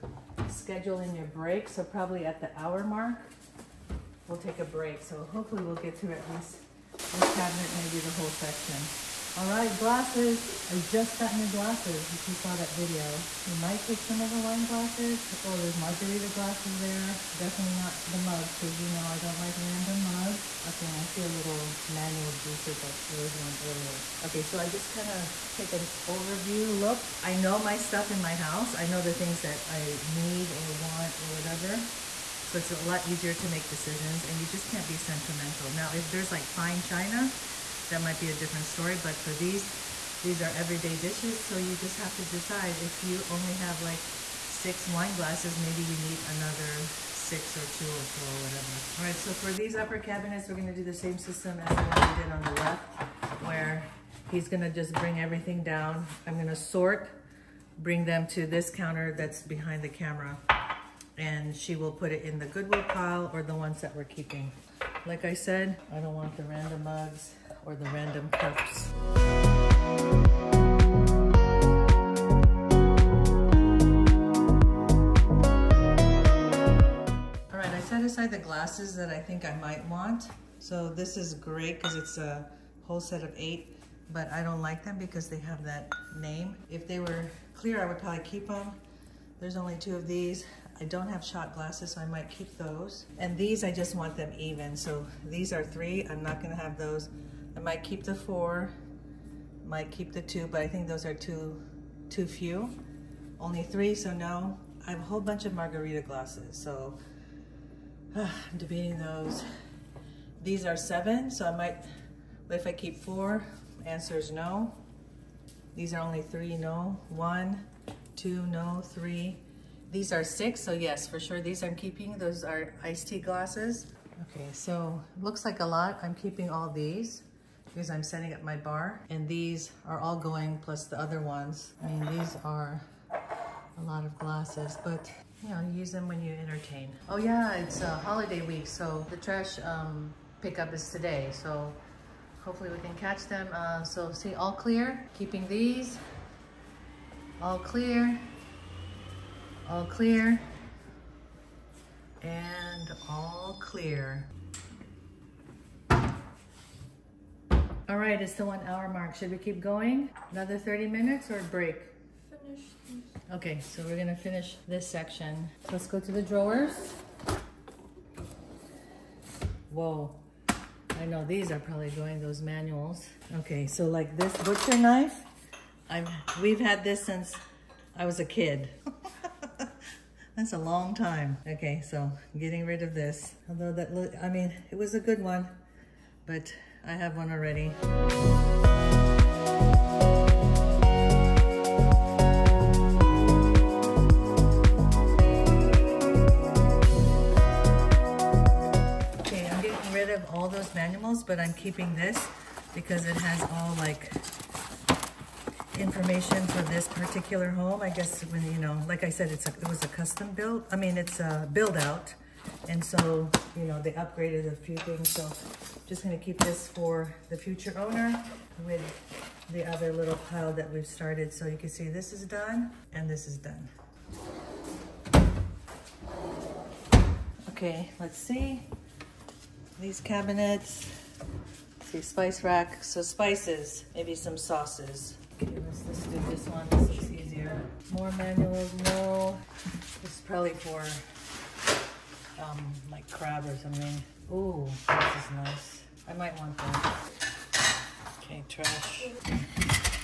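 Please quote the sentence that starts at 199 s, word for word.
Okay, I'm getting rid of all those manuals, but I'm keeping this because it has all like information for this particular home.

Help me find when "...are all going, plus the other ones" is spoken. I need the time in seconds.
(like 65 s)
129 s.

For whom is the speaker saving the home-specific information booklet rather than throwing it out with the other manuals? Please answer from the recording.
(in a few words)
the future owner.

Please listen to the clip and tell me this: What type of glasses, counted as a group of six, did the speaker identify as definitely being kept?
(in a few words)
iced tea glasses.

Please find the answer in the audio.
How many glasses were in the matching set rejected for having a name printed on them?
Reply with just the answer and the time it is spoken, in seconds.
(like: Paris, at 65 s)
8, at 82 s.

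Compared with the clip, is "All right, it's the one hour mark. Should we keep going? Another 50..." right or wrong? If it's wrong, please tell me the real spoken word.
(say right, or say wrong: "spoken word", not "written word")
wrong: "30", not "50".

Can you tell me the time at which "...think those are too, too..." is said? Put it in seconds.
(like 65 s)
100 s.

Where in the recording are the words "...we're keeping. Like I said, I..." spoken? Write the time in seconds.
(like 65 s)
63 s.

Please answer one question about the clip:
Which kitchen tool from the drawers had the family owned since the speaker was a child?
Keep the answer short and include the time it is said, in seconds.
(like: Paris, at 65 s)
butcher knife, at 174 s.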